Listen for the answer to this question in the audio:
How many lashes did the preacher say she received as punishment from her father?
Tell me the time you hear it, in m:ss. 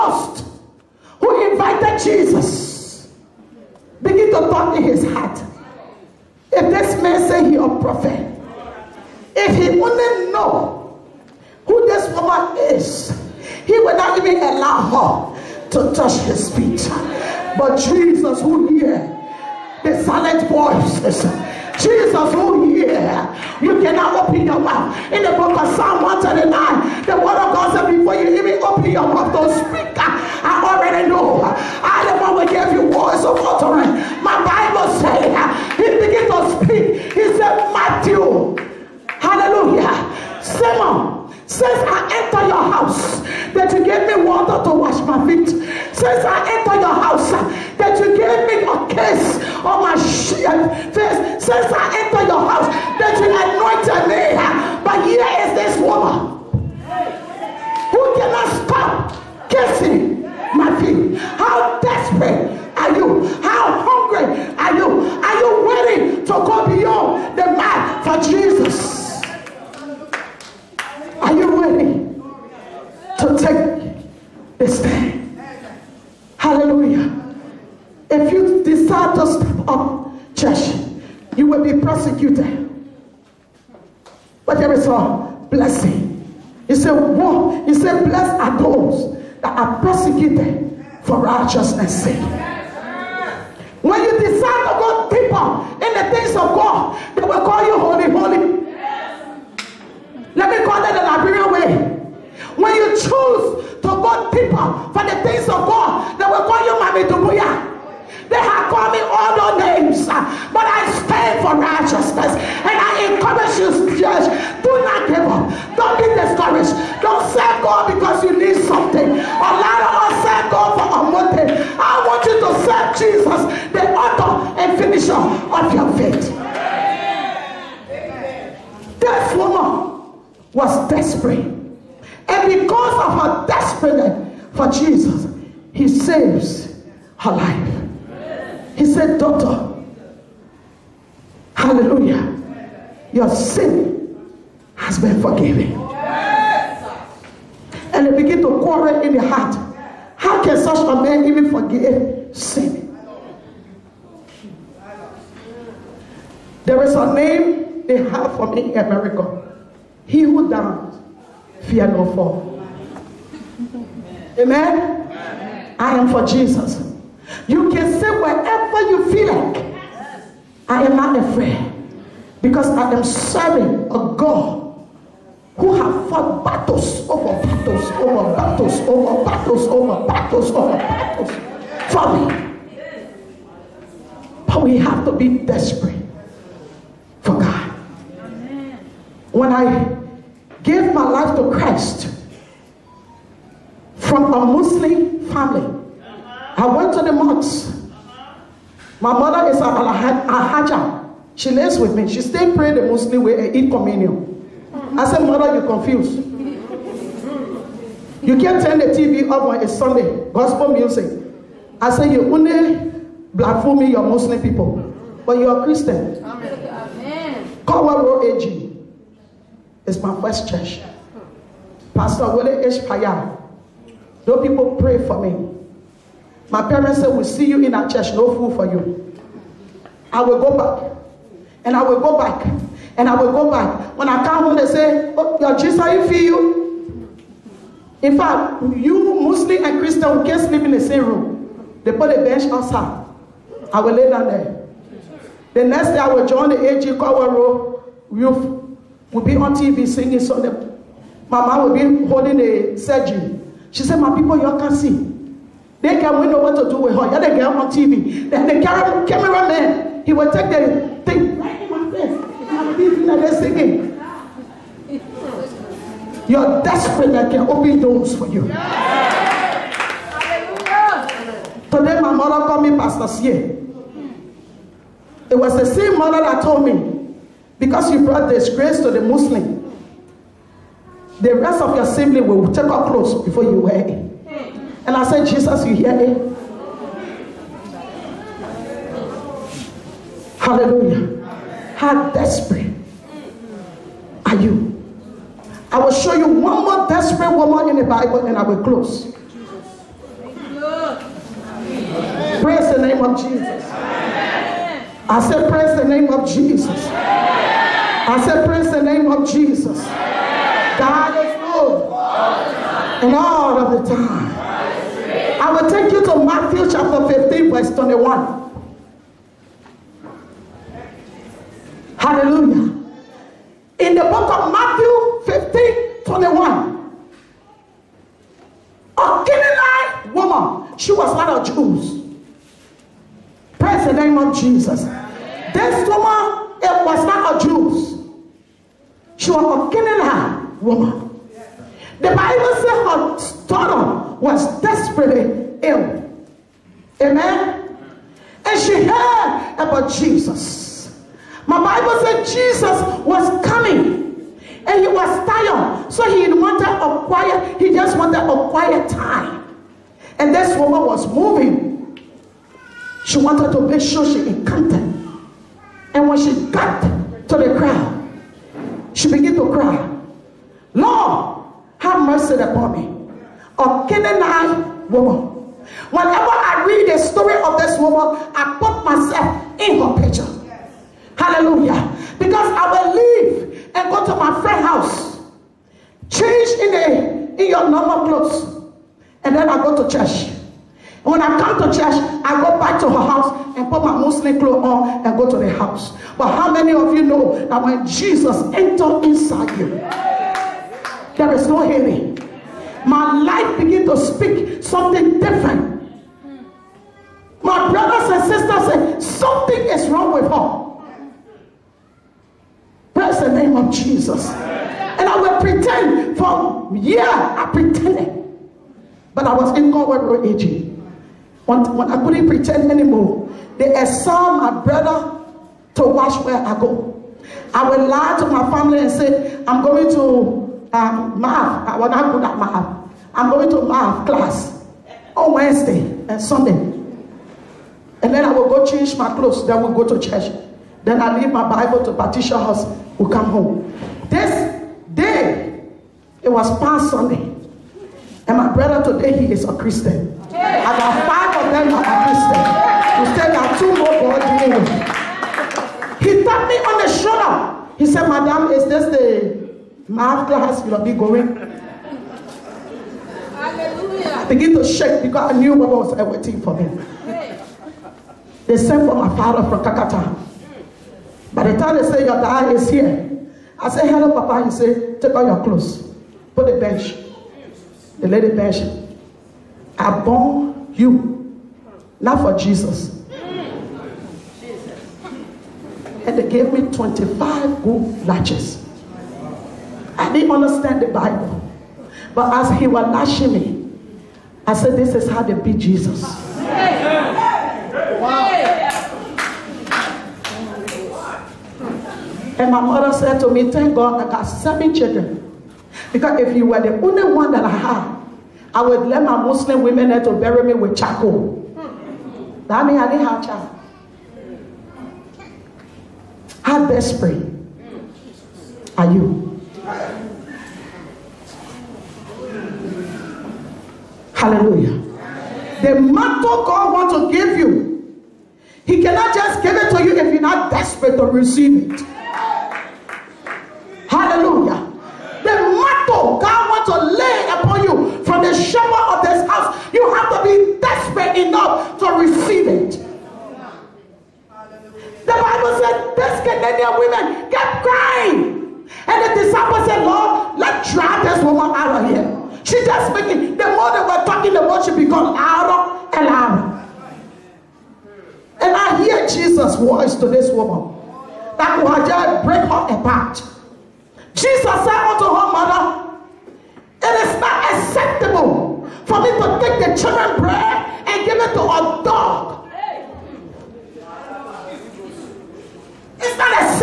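8:06.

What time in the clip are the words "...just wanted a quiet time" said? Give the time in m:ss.
5:57.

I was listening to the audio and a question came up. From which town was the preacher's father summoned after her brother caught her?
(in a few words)
Kakata.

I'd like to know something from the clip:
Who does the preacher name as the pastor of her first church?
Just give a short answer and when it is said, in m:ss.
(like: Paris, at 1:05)
Willie H. Payan, at 3:42.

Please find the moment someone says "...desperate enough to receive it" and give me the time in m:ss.
9:00.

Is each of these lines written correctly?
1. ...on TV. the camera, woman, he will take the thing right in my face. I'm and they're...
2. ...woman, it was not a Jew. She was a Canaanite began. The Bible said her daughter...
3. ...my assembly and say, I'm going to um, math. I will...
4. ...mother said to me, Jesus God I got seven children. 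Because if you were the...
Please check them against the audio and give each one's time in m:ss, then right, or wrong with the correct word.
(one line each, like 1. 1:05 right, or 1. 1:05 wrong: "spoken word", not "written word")
1. 4:17 wrong: "cameraman", not "woman"
2. 5:35 wrong: "woman", not "began"
3. 7:08 wrong: "family", not "assembly"
4. 8:22 wrong: "Thank", not "Jesus".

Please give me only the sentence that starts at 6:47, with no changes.
My brothers and sisters say something is wrong with her.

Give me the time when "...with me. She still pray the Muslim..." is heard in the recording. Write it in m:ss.
3:21.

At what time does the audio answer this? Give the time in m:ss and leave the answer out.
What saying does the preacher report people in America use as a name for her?
2:40.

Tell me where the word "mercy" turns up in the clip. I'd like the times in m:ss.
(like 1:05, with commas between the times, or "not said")
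6:12.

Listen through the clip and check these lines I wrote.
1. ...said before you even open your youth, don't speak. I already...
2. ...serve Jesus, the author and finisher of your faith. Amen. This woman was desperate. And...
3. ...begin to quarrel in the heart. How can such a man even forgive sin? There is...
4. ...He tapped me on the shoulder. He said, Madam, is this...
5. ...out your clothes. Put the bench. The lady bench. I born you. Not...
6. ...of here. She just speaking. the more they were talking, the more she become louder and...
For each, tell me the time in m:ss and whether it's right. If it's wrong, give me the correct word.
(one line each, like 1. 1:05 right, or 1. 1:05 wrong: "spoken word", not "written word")
1. 0:27 wrong: "mouth", not "youth"
2. 2:02 right
3. 2:28 right
4. 7:35 right
5. 7:55 right
6. 9:11 right.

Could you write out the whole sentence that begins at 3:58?
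In fact, you Muslim and Christian we can't sleep in the same room.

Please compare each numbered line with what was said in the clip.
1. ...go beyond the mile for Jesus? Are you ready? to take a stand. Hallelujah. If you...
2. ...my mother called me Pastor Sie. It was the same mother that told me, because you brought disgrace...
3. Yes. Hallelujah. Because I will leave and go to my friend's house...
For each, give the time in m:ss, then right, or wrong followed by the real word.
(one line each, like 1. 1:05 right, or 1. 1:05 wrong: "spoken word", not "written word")
1. 1:06 right
2. 4:32 right
3. 6:20 right.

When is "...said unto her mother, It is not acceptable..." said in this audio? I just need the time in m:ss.
9:24.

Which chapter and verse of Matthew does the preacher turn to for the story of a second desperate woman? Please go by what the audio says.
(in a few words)
Matthew 15:21.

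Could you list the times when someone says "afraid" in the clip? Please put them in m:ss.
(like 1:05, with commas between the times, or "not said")
2:51.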